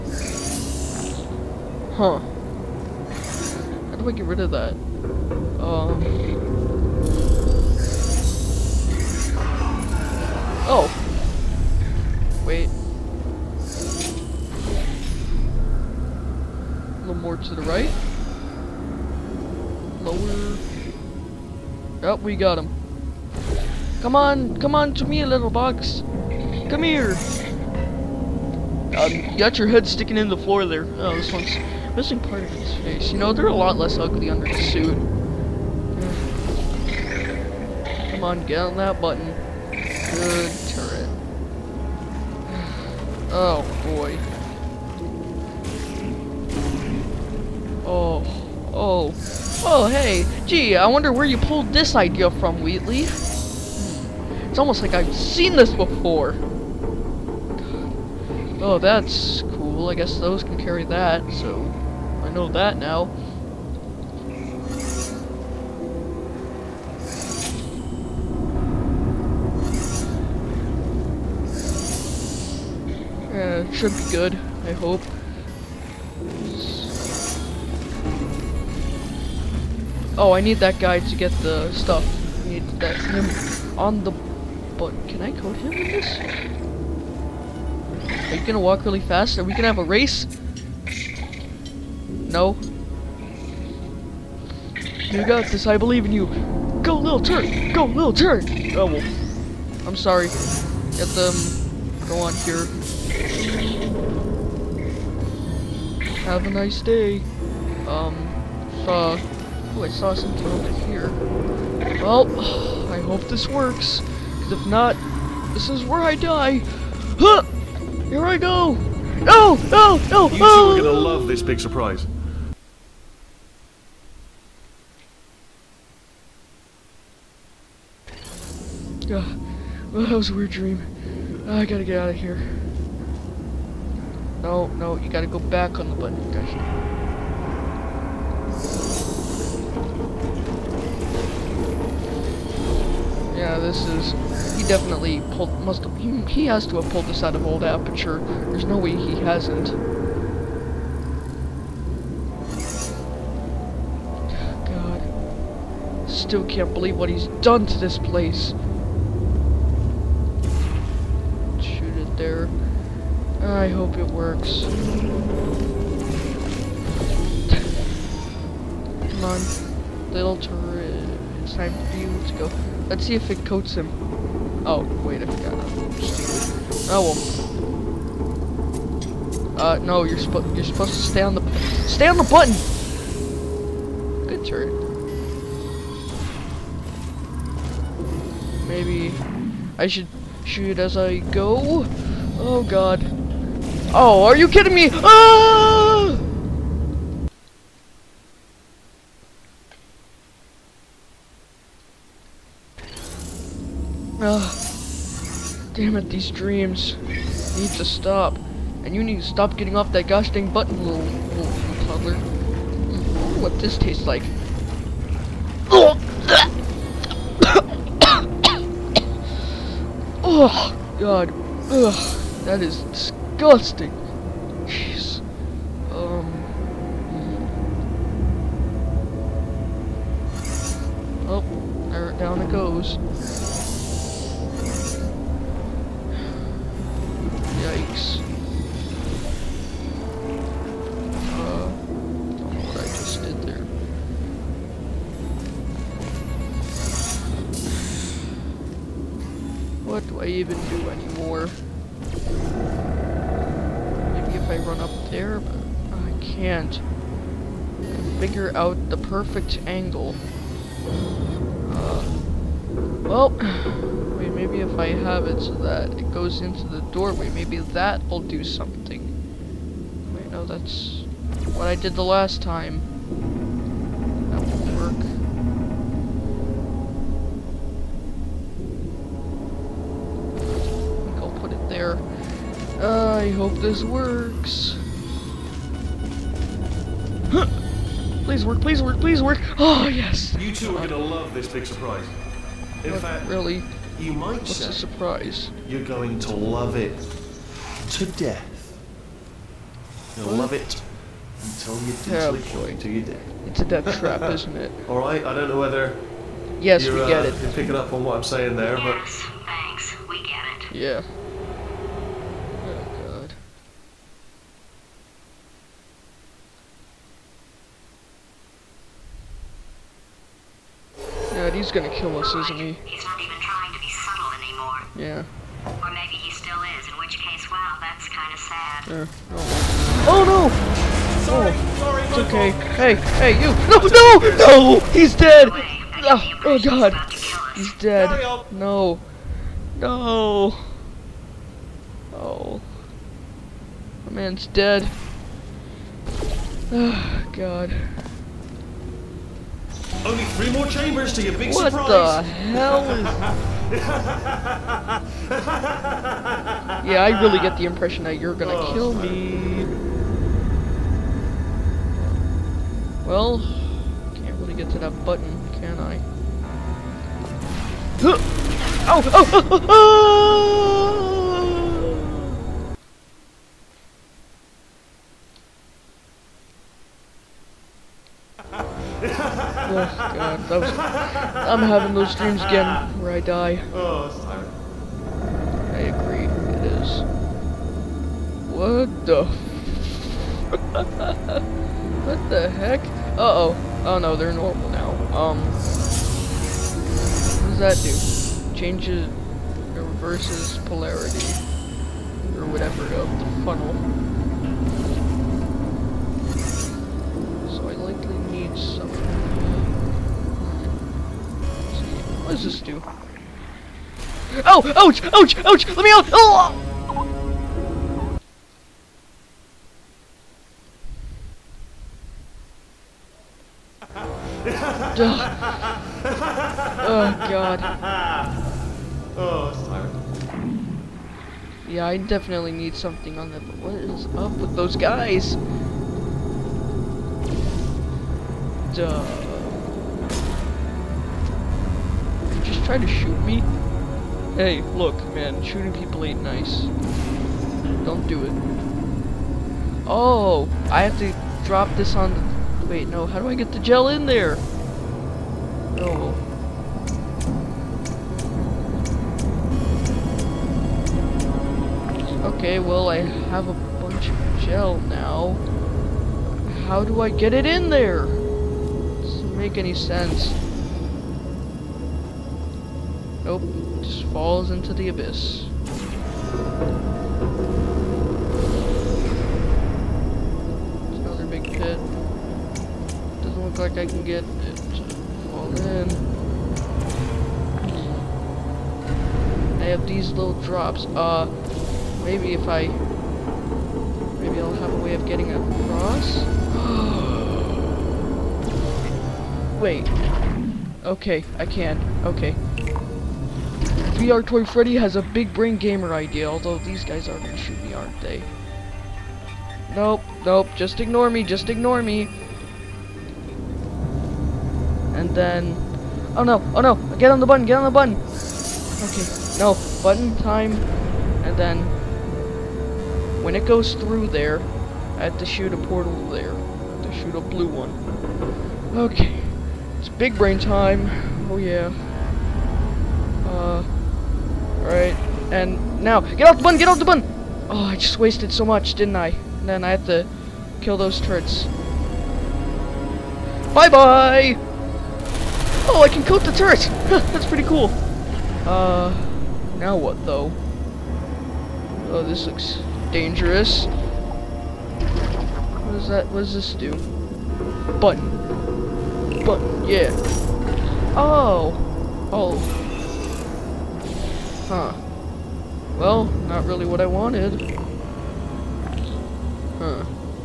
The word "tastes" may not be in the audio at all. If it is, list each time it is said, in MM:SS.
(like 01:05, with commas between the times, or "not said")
03:33.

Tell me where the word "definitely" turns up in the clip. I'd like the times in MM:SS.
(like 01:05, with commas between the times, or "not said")
02:24, 07:11.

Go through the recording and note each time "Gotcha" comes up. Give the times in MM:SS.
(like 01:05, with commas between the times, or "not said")
02:16.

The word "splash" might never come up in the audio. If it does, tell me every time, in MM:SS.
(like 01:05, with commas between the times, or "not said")
not said.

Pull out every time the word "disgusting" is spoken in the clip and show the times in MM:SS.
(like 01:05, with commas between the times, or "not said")
03:42.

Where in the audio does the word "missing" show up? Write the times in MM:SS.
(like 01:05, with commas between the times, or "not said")
00:31.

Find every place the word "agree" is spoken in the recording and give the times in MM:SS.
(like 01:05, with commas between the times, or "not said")
06:25.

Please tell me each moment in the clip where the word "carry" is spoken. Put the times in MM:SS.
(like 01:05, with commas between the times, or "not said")
01:00.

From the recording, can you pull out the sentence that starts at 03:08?
Maybe I should shoot as I go.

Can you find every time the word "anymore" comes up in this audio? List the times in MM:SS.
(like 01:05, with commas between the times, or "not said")
04:10, 05:24.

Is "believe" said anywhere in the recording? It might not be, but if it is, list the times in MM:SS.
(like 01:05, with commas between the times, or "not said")
01:35, 02:36.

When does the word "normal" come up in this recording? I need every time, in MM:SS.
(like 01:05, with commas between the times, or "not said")
06:34.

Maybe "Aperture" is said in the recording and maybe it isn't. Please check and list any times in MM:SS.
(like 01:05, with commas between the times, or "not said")
02:27.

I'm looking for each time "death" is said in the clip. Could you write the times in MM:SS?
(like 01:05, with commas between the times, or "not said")
04:58, 05:03.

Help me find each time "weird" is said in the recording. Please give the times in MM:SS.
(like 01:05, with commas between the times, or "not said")
02:10.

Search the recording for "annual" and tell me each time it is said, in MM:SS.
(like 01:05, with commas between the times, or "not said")
not said.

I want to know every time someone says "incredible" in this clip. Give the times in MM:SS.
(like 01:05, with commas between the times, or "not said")
not said.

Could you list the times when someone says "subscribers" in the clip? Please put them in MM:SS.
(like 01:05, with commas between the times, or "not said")
not said.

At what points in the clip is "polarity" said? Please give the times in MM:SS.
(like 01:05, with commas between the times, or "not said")
06:40.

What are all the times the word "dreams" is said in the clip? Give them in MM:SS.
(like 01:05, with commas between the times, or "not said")
02:10, 03:26, 06:22.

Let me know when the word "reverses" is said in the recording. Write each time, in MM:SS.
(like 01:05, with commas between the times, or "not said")
06:39.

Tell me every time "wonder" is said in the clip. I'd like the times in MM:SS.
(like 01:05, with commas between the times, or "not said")
00:50.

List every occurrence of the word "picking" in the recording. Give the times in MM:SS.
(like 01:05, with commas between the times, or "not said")
05:07.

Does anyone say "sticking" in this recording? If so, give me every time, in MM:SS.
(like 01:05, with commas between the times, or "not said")
00:29.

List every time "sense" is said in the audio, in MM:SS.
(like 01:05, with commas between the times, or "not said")
07:49.